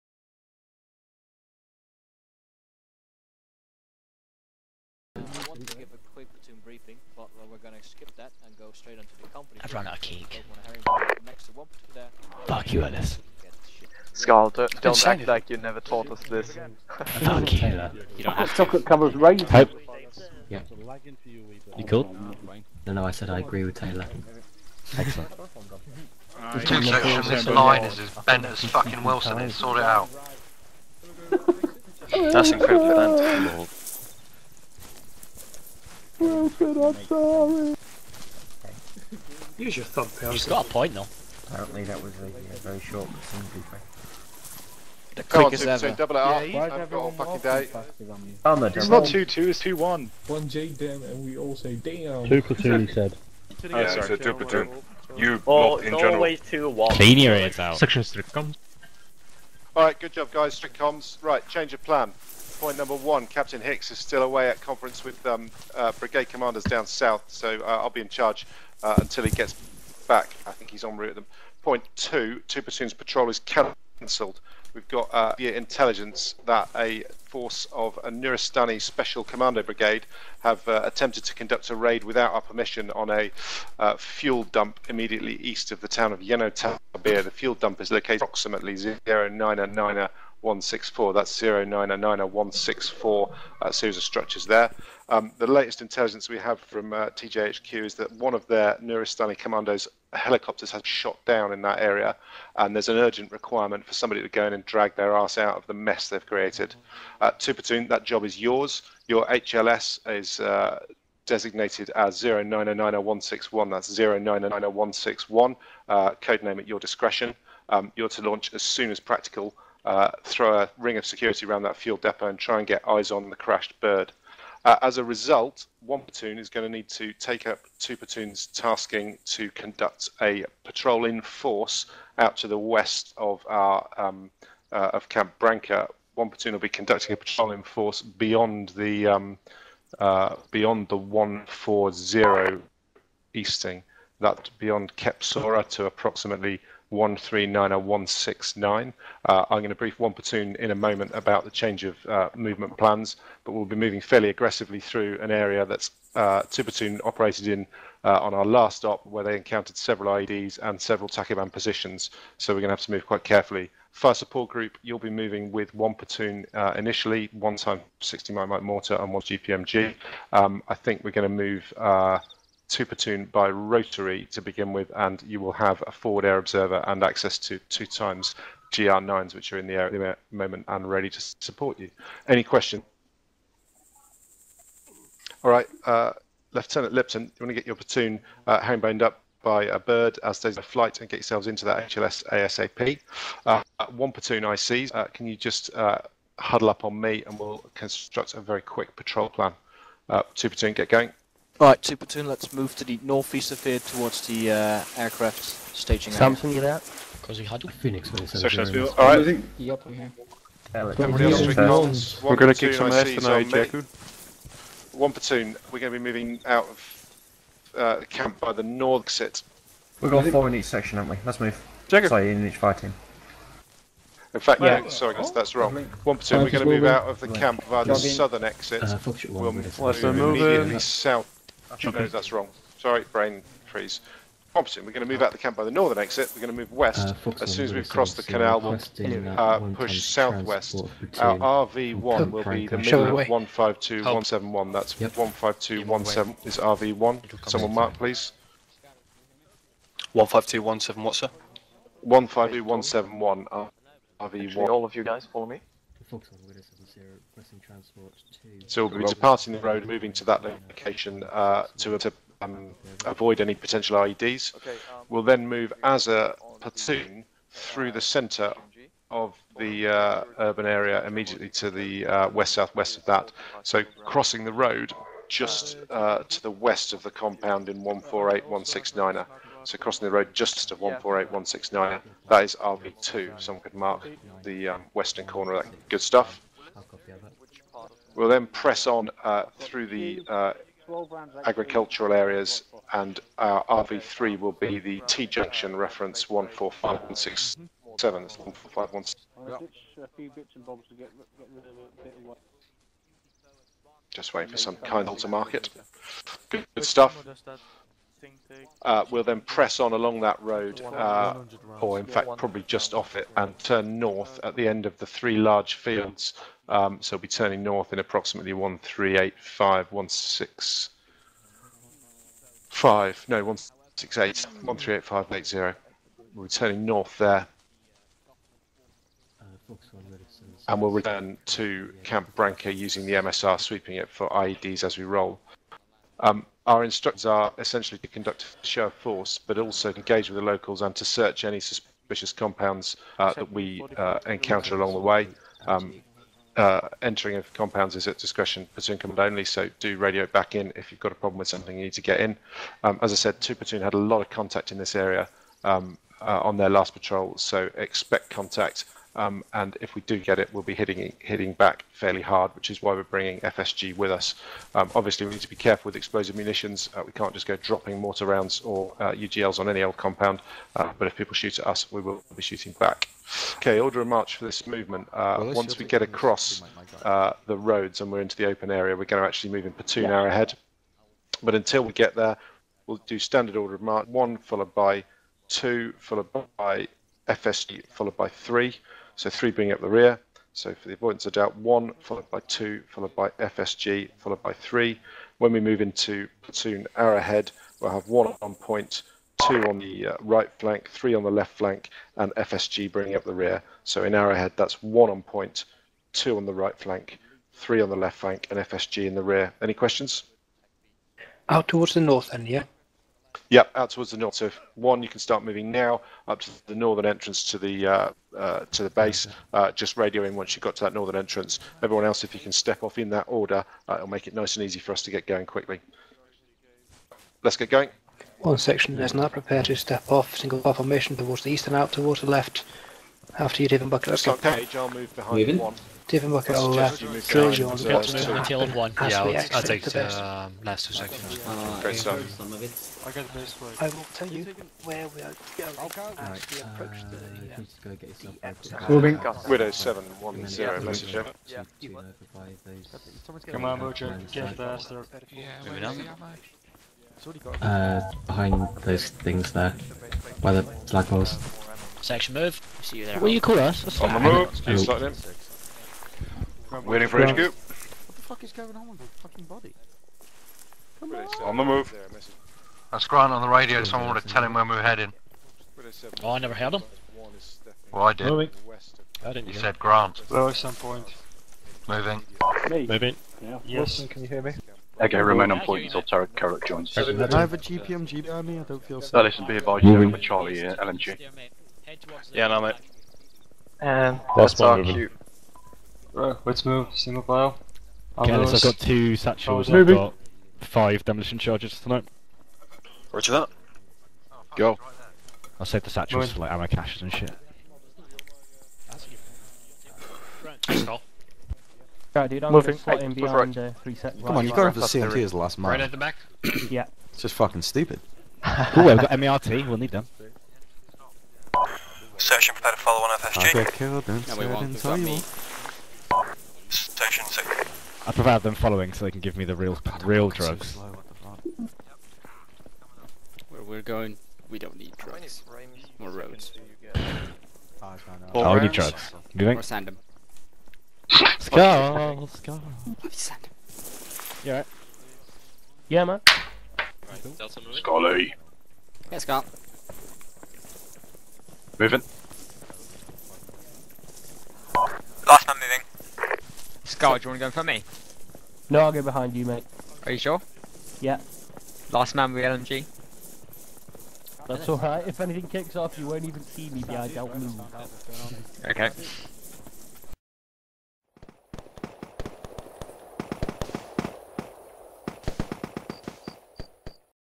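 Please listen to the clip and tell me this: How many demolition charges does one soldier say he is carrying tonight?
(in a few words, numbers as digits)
5.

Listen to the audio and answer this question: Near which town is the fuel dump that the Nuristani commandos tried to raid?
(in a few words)
Yenotabir.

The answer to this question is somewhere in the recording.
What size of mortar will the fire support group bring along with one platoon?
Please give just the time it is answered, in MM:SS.
02:48.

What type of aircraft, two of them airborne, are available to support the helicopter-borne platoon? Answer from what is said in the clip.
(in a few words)
GR9s.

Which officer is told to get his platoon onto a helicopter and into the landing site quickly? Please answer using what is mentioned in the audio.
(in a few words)
Lieutenant Lipton.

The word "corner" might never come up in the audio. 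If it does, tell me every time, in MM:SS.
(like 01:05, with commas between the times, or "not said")
04:45.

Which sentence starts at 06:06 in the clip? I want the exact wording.
Uh, we can't just go dropping mortar rounds or uh, UGLs on any old compound.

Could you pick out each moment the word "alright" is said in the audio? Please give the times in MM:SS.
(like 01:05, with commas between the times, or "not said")
00:59, 03:28, 09:04, 09:24.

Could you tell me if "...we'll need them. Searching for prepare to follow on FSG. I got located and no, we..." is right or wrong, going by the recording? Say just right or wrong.
wrong.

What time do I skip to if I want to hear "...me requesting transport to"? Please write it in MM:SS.
04:15.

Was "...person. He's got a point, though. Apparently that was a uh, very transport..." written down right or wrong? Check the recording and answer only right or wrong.
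wrong.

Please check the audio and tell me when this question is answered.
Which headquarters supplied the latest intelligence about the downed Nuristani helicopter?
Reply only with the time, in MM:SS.
01:37.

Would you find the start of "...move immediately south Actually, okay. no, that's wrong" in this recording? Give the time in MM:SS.
03:49.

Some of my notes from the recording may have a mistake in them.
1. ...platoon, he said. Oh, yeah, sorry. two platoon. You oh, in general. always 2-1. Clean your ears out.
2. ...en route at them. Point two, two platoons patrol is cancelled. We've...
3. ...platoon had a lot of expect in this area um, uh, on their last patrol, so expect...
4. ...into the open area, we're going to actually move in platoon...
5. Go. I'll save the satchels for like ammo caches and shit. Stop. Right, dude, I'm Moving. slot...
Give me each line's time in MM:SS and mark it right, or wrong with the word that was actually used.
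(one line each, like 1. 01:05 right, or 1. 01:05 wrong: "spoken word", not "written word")
1. 00:52 right
2. 01:10 right
3. 05:53 wrong: "contact", not "expect"
4. 06:18 right
5. 08:24 right.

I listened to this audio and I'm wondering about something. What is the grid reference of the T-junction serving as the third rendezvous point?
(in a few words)
145167.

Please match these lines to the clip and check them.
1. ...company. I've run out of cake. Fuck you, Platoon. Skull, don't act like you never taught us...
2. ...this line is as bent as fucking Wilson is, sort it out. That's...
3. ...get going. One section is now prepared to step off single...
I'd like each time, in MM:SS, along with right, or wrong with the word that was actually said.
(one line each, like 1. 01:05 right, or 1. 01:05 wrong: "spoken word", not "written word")
1. 00:09 wrong: "Ellis", not "Platoon"
2. 00:27 right
3. 07:07 right.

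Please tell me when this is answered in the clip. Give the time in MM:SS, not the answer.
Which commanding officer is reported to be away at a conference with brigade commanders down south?
01:03.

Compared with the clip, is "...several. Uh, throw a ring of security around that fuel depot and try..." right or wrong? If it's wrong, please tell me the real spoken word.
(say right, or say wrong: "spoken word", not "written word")
wrong: "practical", not "several".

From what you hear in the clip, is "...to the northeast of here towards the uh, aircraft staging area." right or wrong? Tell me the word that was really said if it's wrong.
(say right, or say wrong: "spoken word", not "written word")
right.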